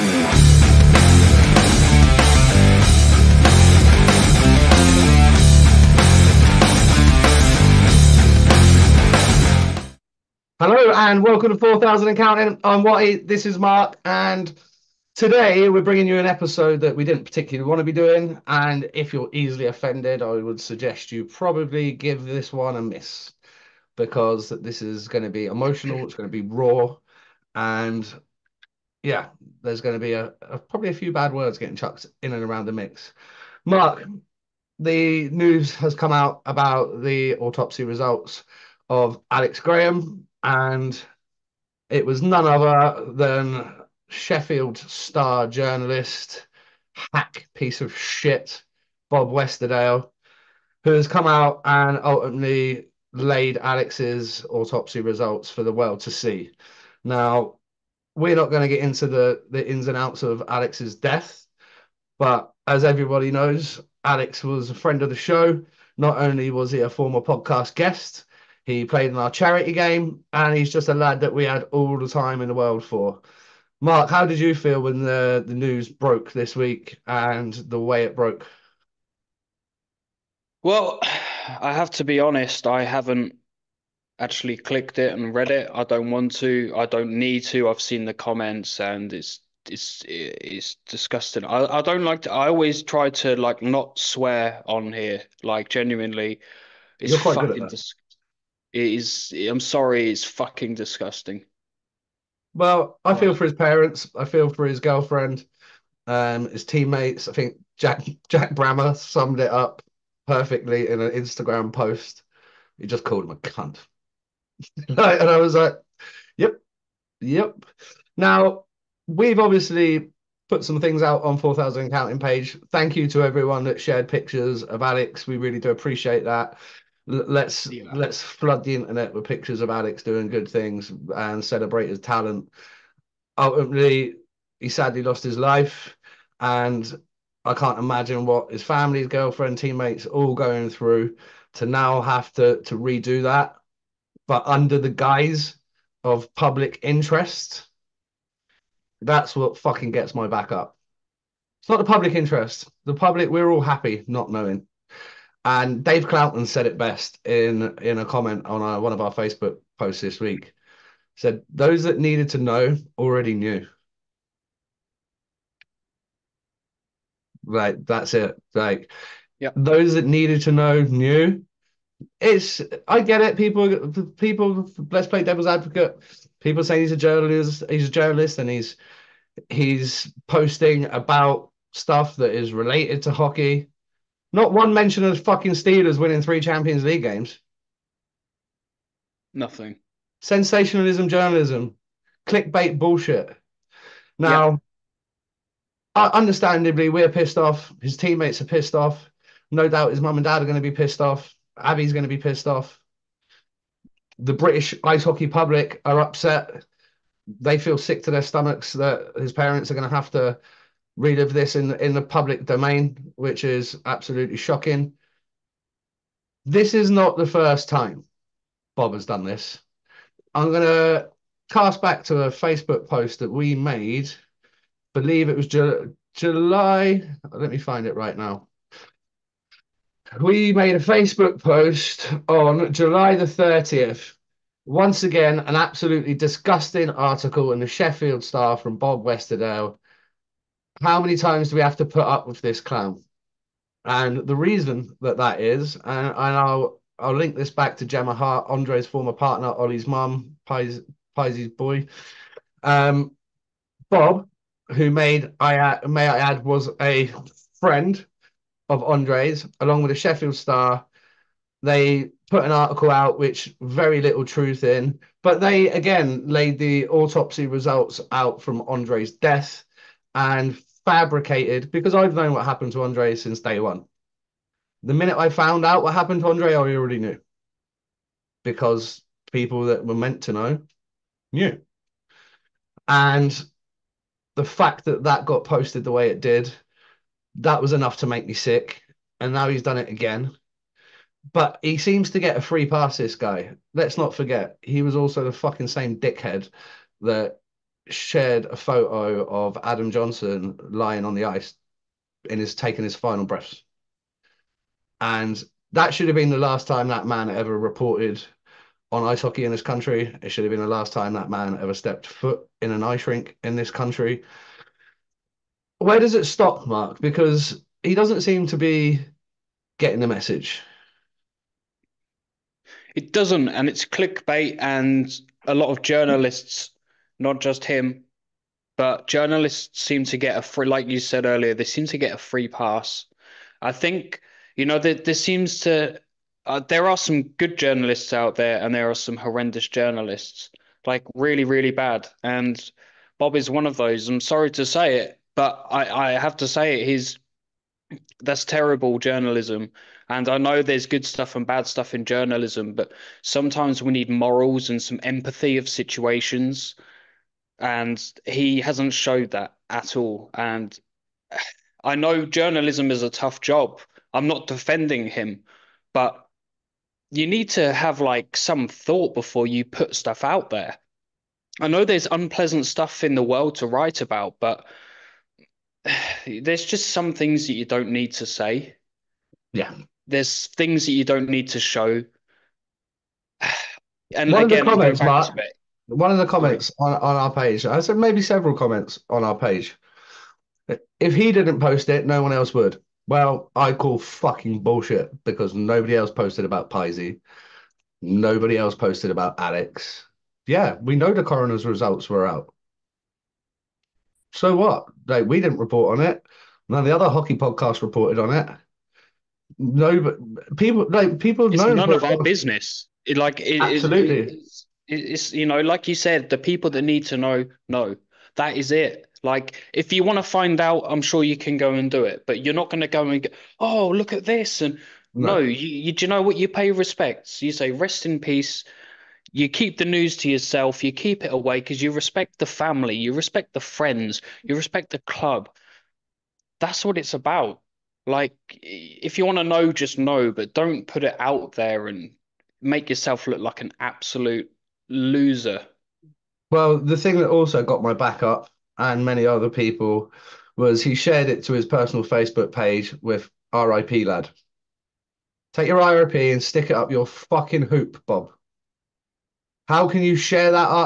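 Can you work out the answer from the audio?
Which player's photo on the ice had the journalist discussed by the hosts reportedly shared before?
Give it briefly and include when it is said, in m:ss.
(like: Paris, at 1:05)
Adam Johnson, at 4:59.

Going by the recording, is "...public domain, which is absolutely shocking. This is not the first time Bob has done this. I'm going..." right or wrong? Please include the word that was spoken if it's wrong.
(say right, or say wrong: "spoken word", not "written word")
right.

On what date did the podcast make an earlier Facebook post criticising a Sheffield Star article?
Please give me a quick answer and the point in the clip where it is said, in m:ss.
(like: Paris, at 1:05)
July 30th, at 3:52.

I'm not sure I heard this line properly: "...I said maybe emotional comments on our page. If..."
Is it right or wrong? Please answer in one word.
wrong.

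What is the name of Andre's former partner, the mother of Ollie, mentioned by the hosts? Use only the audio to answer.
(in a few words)
Gemma Hart.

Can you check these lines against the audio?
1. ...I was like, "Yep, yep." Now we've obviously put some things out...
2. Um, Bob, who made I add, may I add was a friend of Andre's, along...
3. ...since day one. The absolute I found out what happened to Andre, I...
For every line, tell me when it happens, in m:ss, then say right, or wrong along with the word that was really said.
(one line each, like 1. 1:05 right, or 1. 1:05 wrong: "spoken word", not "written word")
1. 1:54 right
2. 4:12 right
3. 4:33 wrong: "minute", not "absolute".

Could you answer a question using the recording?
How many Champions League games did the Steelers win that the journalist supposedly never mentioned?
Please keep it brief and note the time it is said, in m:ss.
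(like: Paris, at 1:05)
3, at 3:06.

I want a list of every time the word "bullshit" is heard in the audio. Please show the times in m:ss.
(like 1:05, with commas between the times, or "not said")
3:12, 6:34.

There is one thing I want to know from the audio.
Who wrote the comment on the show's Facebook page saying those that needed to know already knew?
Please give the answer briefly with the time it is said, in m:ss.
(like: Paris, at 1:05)
Dave Clouton, at 2:35.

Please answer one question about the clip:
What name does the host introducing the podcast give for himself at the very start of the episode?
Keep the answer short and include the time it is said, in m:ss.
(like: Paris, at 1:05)
Watty, at 0:12.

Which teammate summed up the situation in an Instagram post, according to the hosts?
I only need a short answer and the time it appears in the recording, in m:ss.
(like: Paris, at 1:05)
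Jack Brammer, at 1:48.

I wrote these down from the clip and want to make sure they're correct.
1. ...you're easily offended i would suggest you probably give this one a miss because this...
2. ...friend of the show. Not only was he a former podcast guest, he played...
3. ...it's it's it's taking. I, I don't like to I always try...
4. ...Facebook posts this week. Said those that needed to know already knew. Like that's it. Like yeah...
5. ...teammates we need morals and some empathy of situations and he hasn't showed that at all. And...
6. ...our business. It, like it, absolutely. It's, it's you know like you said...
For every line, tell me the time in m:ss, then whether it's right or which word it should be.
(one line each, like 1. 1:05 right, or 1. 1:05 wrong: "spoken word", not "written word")
1. 0:19 right
2. 1:04 right
3. 1:29 wrong: "disgusting", not "taking"
4. 2:39 right
5. 5:53 wrong: "sometimes", not "teammates"
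6. 6:52 right.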